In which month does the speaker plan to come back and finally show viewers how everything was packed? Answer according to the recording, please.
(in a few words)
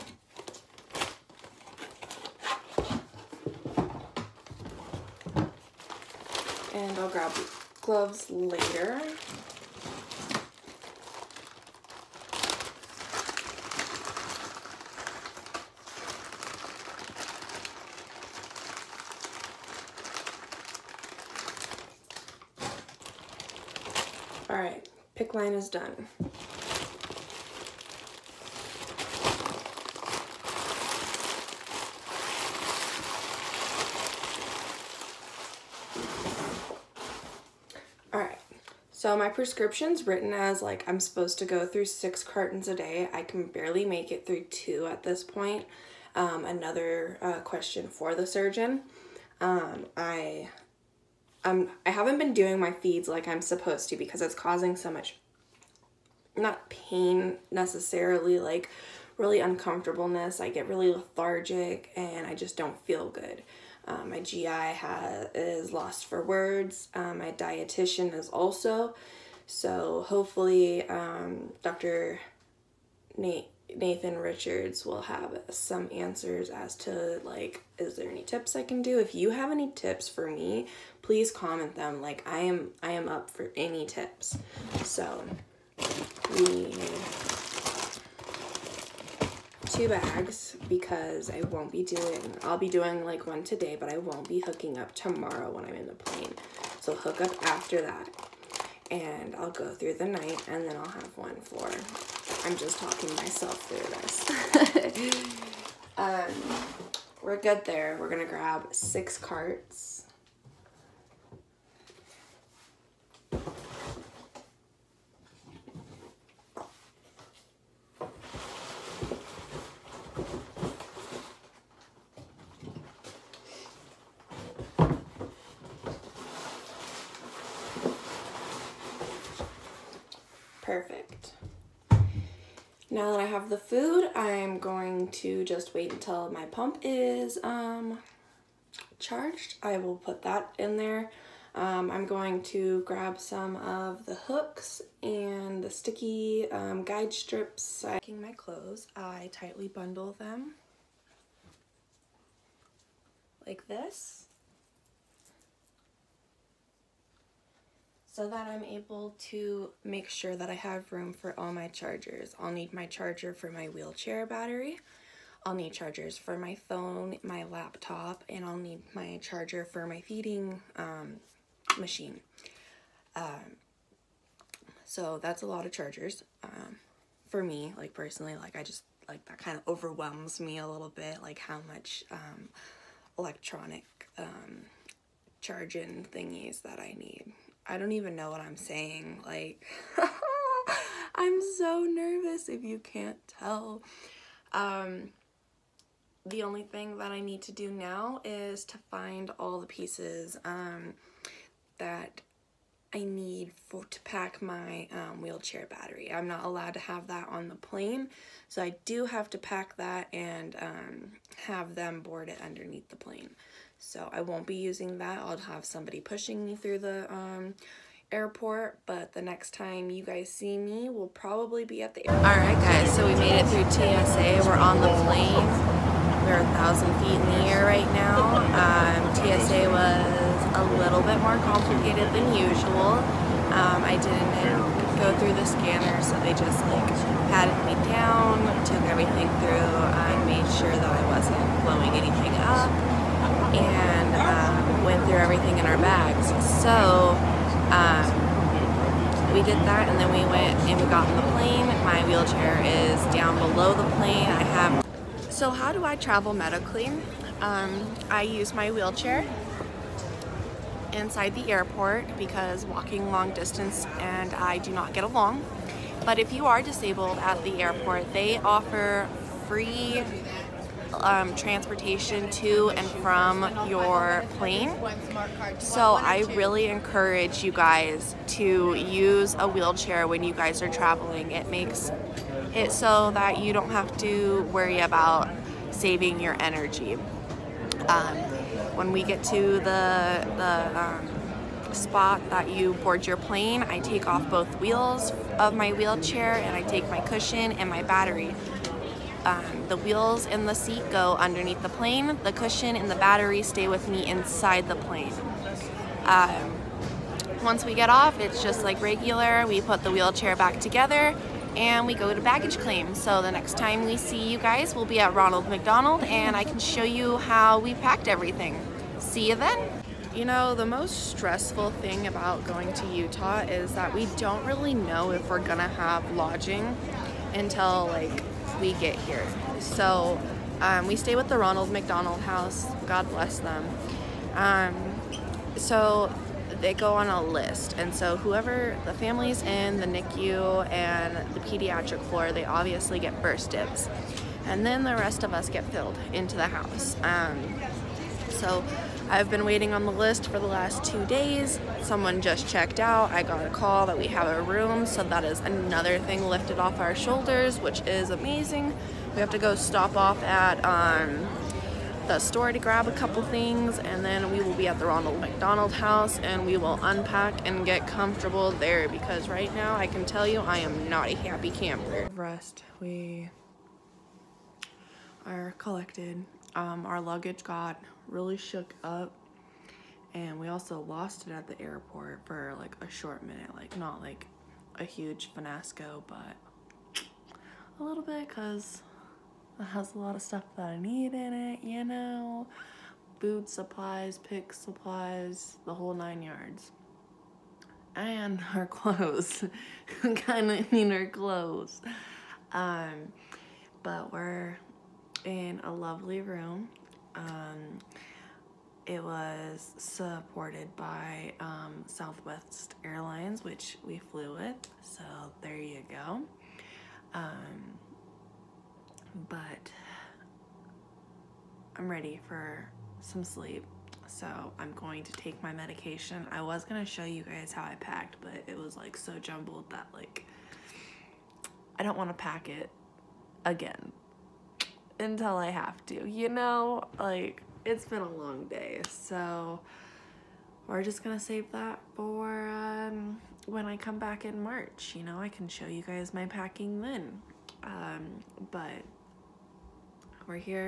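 March.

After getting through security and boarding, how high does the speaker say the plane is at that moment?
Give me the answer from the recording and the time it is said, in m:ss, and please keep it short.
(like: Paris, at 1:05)
1,000 feet, at 3:46.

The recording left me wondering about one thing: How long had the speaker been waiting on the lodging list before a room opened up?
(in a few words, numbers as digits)
2 days.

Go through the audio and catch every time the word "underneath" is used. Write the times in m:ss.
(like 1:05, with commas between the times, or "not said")
3:32, 5:01.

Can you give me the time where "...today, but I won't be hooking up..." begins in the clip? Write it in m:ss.
1:33.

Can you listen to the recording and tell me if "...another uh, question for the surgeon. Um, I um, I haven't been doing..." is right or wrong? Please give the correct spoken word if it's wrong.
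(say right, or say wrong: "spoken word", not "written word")
right.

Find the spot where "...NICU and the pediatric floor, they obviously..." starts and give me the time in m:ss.
5:39.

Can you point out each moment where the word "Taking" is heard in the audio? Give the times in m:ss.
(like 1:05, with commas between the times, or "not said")
2:27.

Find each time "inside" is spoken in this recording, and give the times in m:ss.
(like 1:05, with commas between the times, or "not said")
4:20, 5:04.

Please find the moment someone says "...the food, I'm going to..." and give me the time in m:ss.
2:13.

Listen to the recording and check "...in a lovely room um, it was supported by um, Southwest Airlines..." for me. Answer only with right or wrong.
right.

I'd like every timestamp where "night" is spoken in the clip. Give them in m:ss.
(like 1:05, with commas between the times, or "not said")
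1:40.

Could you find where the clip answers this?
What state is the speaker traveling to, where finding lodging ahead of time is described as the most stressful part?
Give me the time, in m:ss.
5:22.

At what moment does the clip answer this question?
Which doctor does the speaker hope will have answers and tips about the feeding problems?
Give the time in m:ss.
1:13.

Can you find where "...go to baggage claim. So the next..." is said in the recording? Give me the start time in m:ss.
5:11.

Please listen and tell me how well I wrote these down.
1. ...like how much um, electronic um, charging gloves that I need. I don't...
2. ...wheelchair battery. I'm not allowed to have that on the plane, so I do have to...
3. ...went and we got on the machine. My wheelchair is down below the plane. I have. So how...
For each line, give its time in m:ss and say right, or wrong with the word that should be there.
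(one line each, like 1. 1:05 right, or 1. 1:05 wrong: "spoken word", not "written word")
1. 3:01 wrong: "thingies", not "gloves"
2. 3:25 right
3. 4:10 wrong: "plane", not "machine".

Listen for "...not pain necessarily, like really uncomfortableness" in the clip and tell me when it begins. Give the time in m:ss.
0:56.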